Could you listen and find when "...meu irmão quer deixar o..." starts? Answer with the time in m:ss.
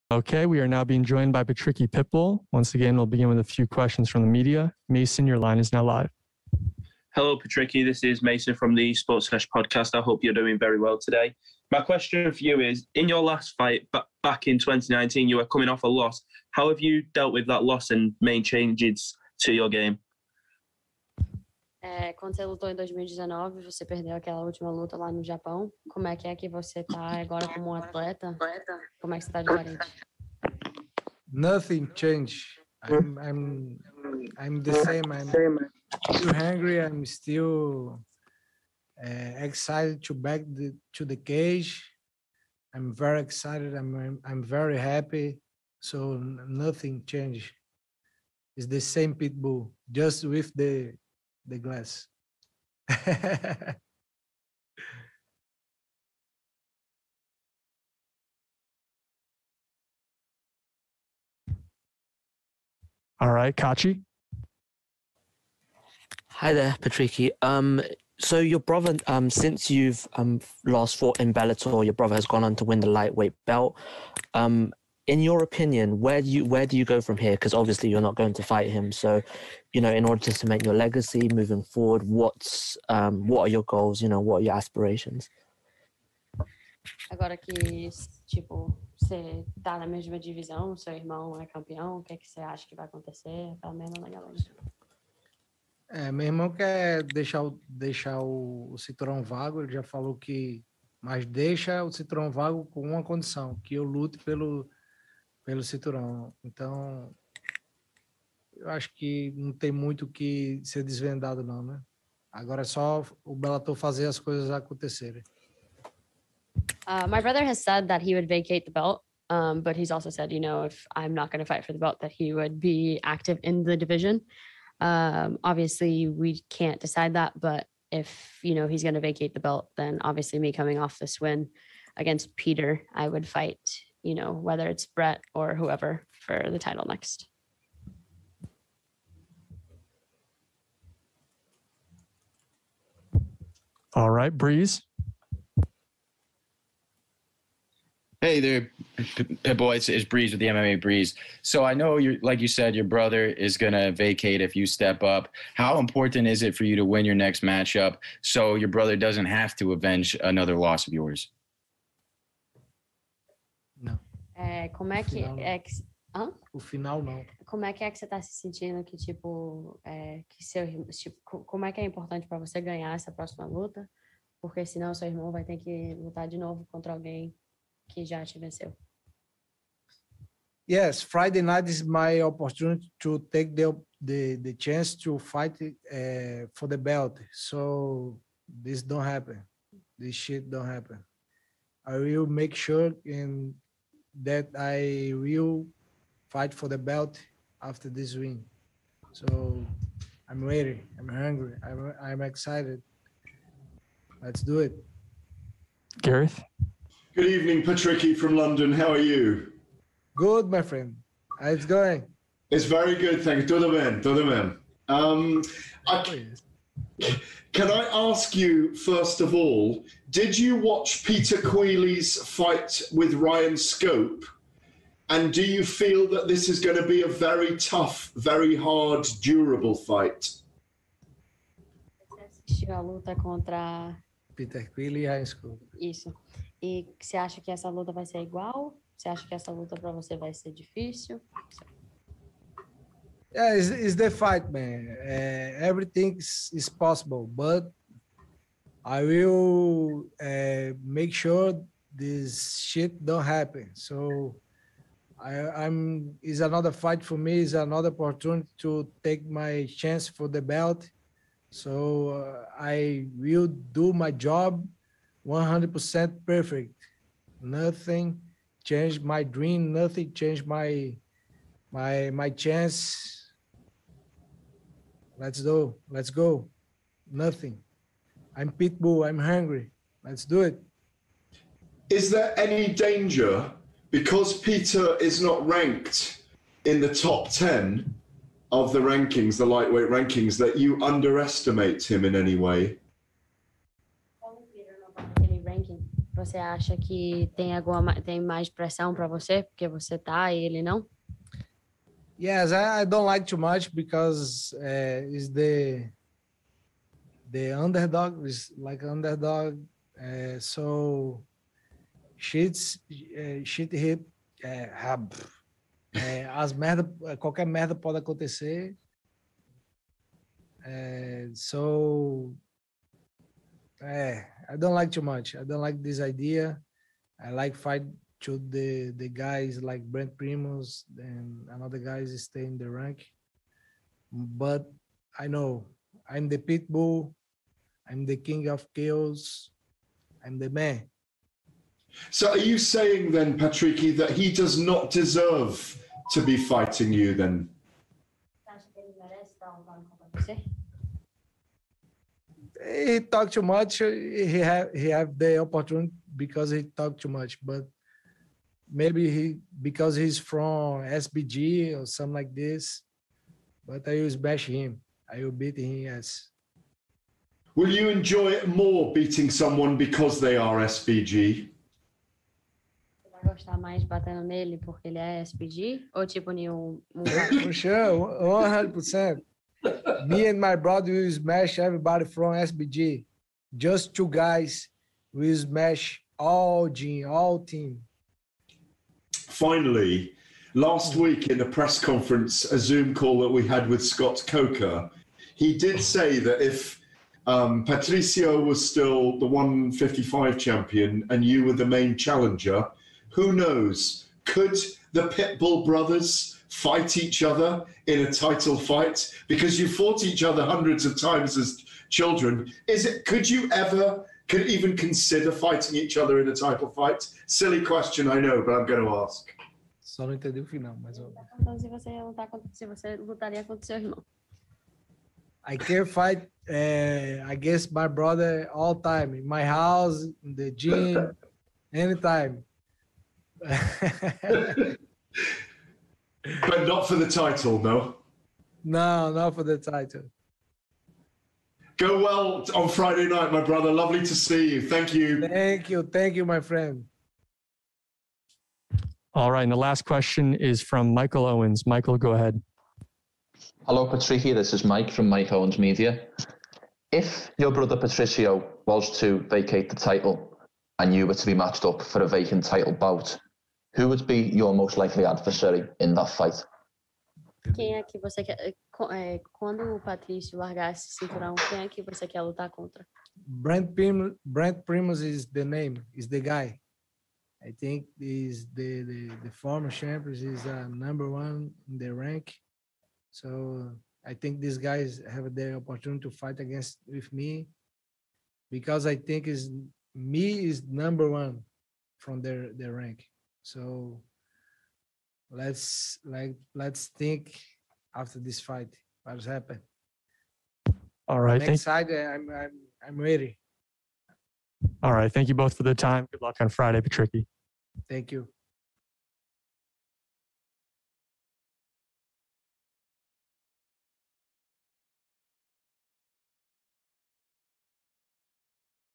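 1:36.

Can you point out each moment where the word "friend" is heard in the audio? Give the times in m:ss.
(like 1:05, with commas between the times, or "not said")
3:30, 7:26.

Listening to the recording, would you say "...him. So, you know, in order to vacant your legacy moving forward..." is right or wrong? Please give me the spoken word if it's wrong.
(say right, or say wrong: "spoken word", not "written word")
wrong: "cement", not "vacant".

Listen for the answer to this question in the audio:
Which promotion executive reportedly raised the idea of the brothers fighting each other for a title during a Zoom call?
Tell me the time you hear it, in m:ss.
6:33.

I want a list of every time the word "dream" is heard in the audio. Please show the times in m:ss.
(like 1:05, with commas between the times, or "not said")
4:29.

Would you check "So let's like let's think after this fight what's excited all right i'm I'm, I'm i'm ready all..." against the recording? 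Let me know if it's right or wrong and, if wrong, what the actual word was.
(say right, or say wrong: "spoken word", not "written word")
wrong: "happened", not "excited".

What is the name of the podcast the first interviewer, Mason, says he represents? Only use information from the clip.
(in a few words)
Sports Fresh.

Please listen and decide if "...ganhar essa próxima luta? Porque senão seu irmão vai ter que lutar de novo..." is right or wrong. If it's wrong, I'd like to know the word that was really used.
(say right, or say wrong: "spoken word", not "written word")
right.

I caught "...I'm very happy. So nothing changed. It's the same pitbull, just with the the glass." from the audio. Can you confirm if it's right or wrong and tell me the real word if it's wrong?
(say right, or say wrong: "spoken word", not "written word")
right.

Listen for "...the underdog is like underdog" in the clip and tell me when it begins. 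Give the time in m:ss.
5:07.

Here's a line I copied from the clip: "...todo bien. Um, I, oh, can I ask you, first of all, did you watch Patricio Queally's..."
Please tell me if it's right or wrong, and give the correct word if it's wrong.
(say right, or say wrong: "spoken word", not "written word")
wrong: "Peter", not "Patricio".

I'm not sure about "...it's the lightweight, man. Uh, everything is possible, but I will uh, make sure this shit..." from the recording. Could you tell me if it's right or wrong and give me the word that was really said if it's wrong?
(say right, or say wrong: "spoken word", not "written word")
wrong: "fight", not "lightweight".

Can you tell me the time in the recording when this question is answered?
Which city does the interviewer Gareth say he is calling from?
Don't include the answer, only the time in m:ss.
3:28.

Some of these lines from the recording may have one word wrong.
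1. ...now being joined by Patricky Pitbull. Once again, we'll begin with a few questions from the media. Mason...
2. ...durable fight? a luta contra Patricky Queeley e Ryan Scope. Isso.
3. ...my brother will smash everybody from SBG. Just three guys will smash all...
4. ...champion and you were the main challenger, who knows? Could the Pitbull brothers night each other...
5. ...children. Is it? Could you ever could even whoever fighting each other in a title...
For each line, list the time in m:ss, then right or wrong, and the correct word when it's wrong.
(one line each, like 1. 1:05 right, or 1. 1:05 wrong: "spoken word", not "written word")
1. 0:00 right
2. 3:49 wrong: "Peter", not "Patricky"
3. 6:20 wrong: "two", not "three"
4. 6:40 wrong: "fight", not "night"
5. 6:51 wrong: "consider", not "whoever".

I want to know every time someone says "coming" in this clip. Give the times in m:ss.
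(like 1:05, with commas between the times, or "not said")
0:15, 2:10.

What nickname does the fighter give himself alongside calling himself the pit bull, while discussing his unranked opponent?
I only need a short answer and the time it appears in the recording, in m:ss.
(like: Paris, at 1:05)
King of chaos, at 5:38.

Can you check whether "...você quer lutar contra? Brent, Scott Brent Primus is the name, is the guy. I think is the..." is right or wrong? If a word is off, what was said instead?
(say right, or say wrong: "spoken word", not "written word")
wrong: "Prim", not "Scott".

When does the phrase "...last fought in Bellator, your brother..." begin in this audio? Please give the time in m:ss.
1:10.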